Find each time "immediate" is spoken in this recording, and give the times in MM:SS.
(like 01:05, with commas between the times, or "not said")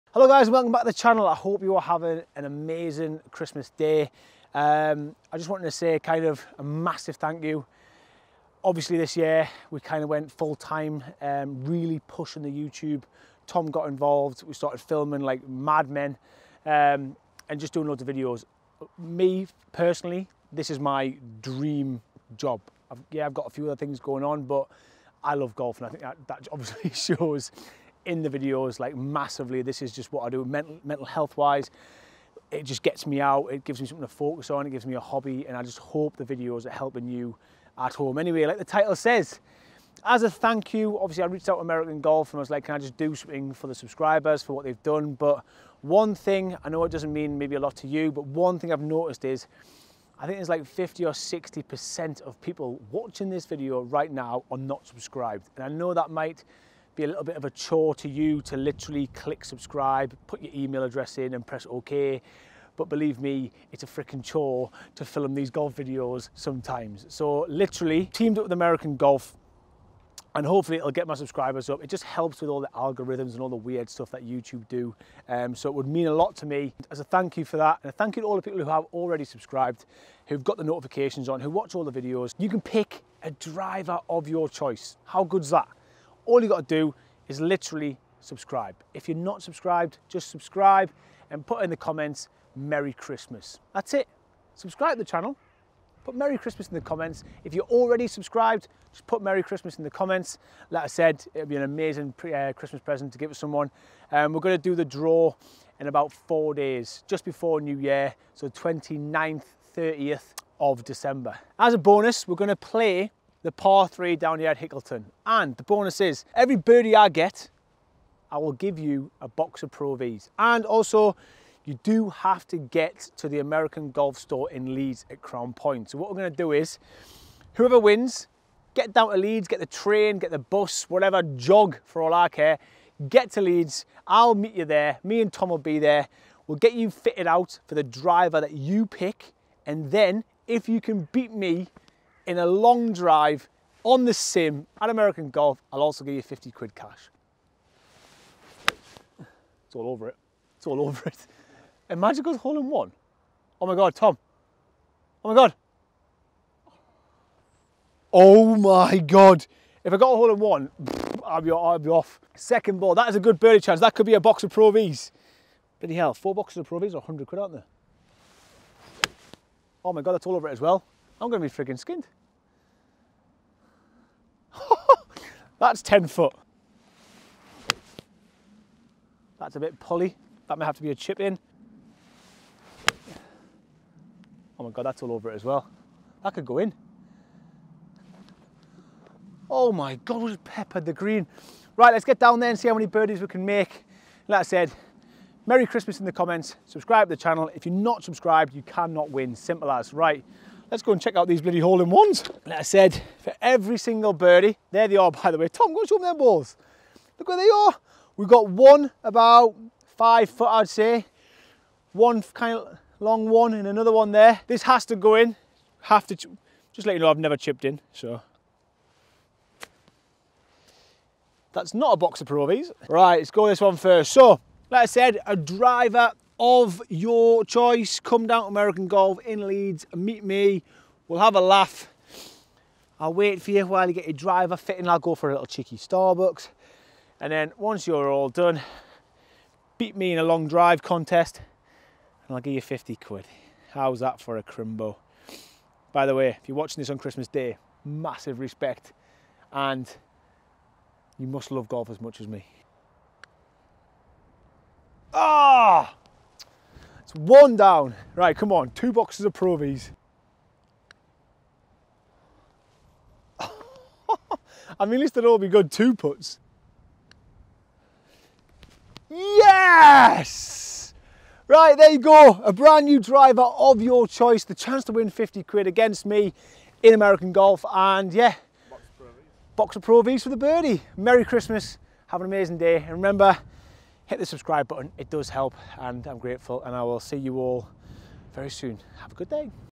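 not said.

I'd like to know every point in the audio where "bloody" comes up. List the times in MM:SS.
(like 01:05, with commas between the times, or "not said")
02:45, 03:21.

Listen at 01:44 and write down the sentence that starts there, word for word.
Um, we're gonna do the draw in about four days, just before New Year, so 29th, 30th of December.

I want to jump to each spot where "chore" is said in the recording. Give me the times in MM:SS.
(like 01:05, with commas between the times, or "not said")
00:57, 01:04.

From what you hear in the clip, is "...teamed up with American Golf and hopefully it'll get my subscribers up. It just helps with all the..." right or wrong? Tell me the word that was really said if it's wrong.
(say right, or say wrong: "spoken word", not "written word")
right.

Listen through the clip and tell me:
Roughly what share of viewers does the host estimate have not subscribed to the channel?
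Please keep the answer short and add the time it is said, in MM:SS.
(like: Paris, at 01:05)
50 or 60%, at 00:50.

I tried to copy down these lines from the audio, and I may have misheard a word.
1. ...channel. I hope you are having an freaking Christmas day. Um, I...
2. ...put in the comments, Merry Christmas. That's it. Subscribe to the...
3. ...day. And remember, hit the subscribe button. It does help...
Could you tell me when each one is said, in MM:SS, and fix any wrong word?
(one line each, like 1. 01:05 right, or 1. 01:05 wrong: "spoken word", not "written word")
1. 00:00 wrong: "amazing", not "freaking"
2. 01:31 right
3. 04:42 right.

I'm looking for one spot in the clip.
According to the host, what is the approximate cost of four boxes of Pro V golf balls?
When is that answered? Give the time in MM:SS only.
02:46.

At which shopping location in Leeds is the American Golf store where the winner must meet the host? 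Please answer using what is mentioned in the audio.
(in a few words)
Crown Point.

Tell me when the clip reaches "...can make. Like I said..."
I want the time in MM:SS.
03:13.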